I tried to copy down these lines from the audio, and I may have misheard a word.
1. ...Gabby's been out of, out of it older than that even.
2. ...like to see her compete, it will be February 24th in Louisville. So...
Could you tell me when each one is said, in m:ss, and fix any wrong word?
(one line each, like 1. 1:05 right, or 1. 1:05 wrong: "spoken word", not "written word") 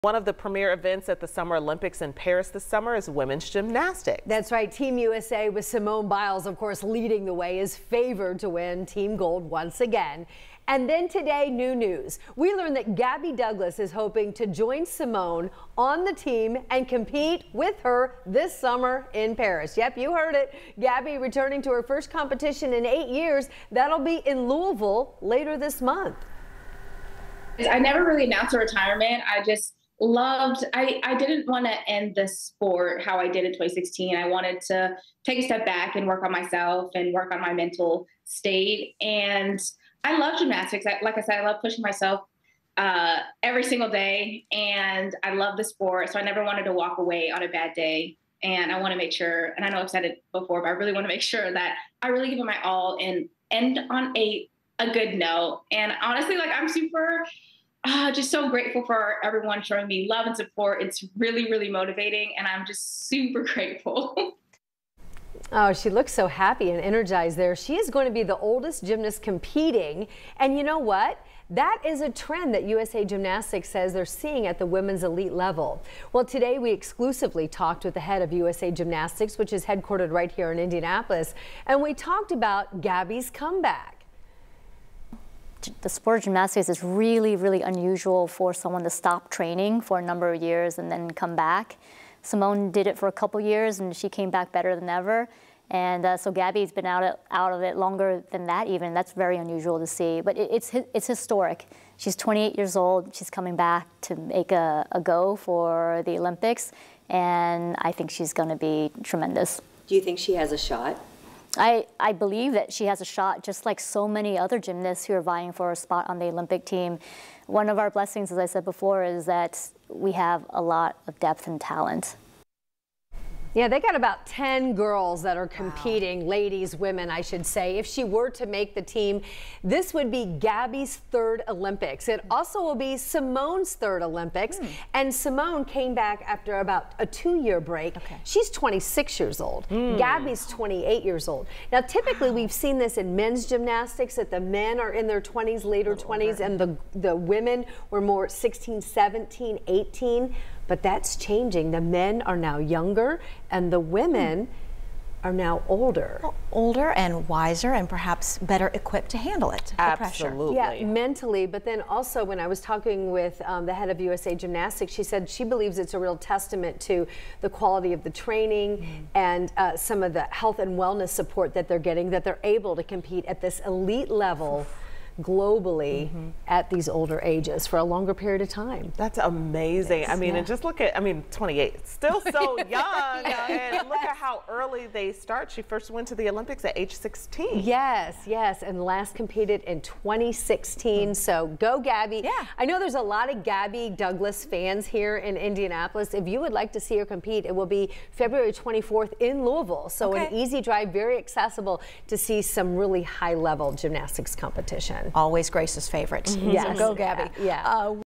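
1. 1:36 wrong: "longer", not "older"
2. 3:16 right.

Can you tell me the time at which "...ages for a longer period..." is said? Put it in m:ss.
2:57.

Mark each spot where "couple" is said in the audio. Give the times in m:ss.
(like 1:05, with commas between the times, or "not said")
1:33.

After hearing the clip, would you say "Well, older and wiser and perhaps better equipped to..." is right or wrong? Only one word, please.
right.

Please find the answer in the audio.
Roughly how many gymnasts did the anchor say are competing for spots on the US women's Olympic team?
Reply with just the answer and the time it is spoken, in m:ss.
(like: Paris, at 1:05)
10, at 2:04.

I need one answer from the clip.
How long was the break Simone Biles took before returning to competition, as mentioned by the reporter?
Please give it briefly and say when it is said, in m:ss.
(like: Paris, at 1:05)
2 years, at 2:17.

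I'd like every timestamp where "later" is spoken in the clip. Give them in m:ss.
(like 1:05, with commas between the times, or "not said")
0:25, 2:25.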